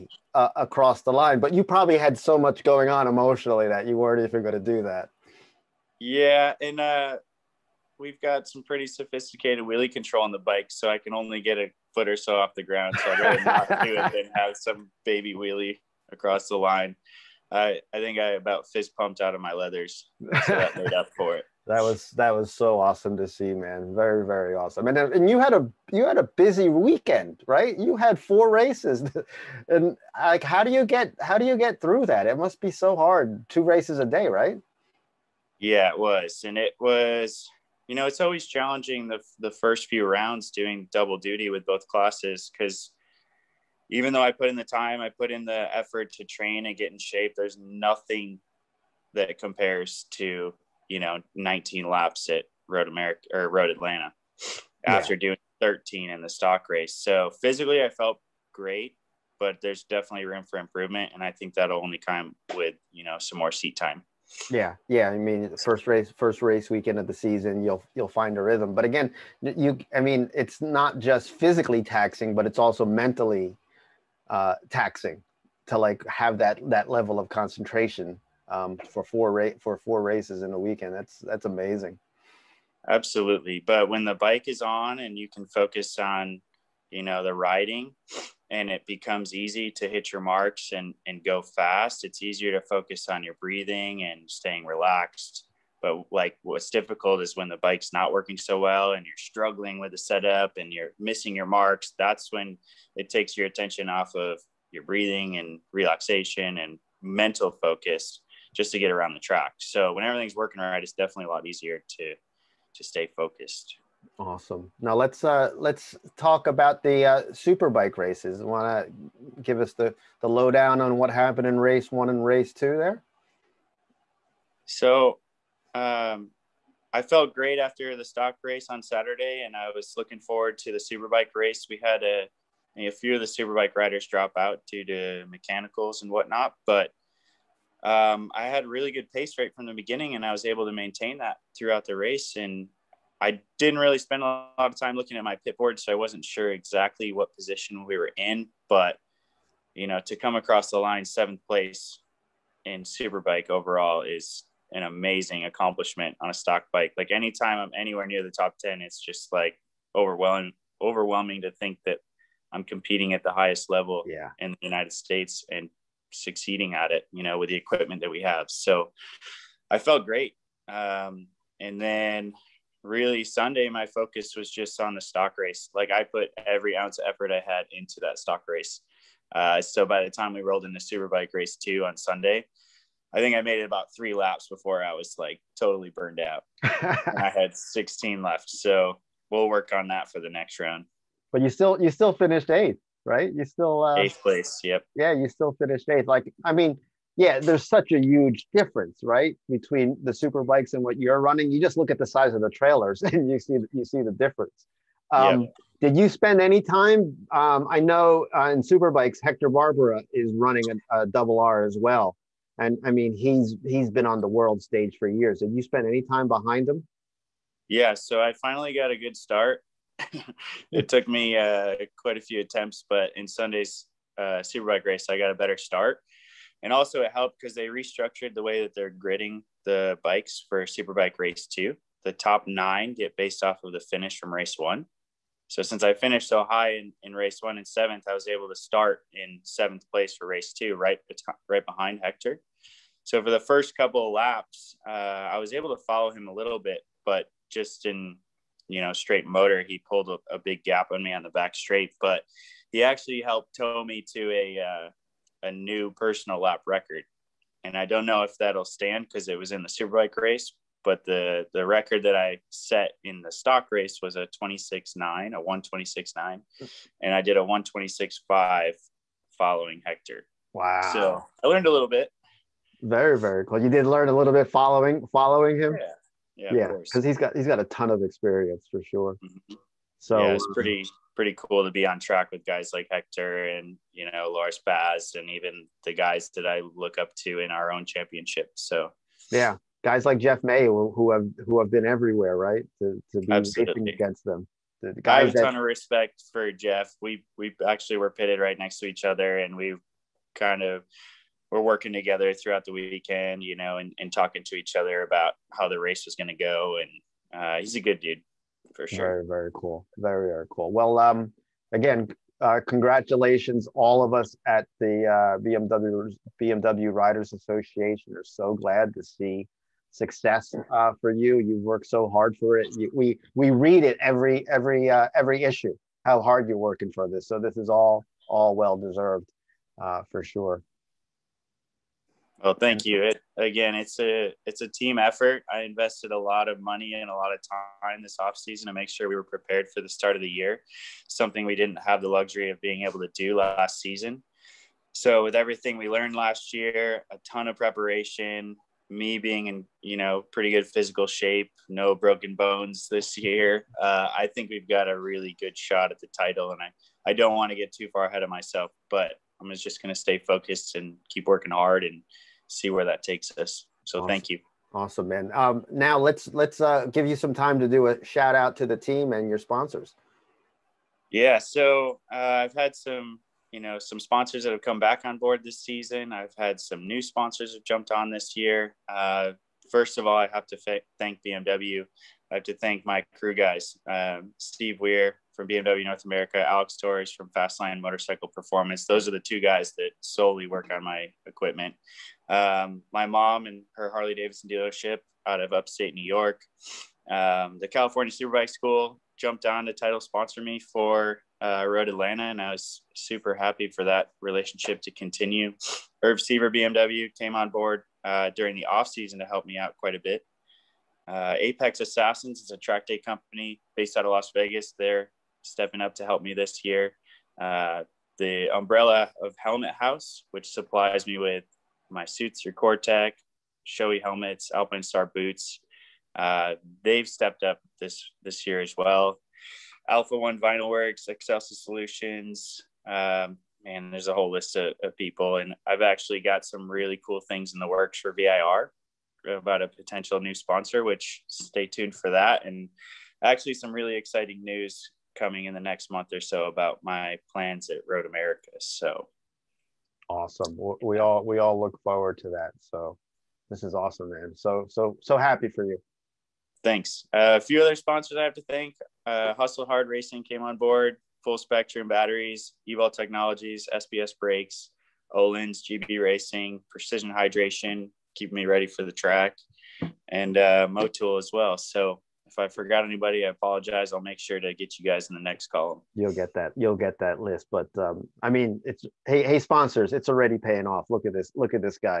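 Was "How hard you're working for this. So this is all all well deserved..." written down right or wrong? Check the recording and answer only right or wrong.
right.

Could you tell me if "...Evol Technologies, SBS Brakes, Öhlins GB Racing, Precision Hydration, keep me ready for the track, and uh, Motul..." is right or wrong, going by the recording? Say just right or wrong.
right.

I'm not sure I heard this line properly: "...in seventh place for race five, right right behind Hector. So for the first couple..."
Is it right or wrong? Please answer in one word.
wrong.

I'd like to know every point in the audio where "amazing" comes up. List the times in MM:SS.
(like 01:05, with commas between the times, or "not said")
01:21, 02:34.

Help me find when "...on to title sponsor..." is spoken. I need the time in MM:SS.
06:39.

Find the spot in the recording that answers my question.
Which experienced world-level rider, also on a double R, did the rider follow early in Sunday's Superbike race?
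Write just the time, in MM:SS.
03:29.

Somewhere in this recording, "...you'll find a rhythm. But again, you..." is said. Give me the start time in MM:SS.
01:07.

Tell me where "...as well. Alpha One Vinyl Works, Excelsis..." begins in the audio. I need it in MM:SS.
07:08.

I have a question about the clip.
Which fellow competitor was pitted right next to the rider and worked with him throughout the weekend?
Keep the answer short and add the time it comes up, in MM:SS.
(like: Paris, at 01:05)
Jeff May, at 04:50.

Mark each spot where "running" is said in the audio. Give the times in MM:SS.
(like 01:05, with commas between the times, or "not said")
03:21, 03:30.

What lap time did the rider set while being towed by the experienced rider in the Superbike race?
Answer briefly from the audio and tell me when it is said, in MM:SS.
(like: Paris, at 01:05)
1:26.5, at 04:27.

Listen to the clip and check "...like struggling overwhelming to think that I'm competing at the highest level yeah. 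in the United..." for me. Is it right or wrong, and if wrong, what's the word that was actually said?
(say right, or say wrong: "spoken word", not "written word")
wrong: "overwhelming", not "struggling".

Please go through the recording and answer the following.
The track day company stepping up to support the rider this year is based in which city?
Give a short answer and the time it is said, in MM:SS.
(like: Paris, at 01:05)
Las Vegas, at 06:54.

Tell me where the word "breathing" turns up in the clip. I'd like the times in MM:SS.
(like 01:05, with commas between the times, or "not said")
01:33, 01:44.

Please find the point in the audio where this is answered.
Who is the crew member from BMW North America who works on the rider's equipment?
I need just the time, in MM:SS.
06:24.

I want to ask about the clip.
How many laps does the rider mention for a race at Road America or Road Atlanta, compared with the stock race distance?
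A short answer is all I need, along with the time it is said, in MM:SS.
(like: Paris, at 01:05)
19, at 00:51.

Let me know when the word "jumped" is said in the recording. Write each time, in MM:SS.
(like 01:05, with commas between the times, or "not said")
06:17, 06:39.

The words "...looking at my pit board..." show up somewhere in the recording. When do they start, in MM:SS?
02:24.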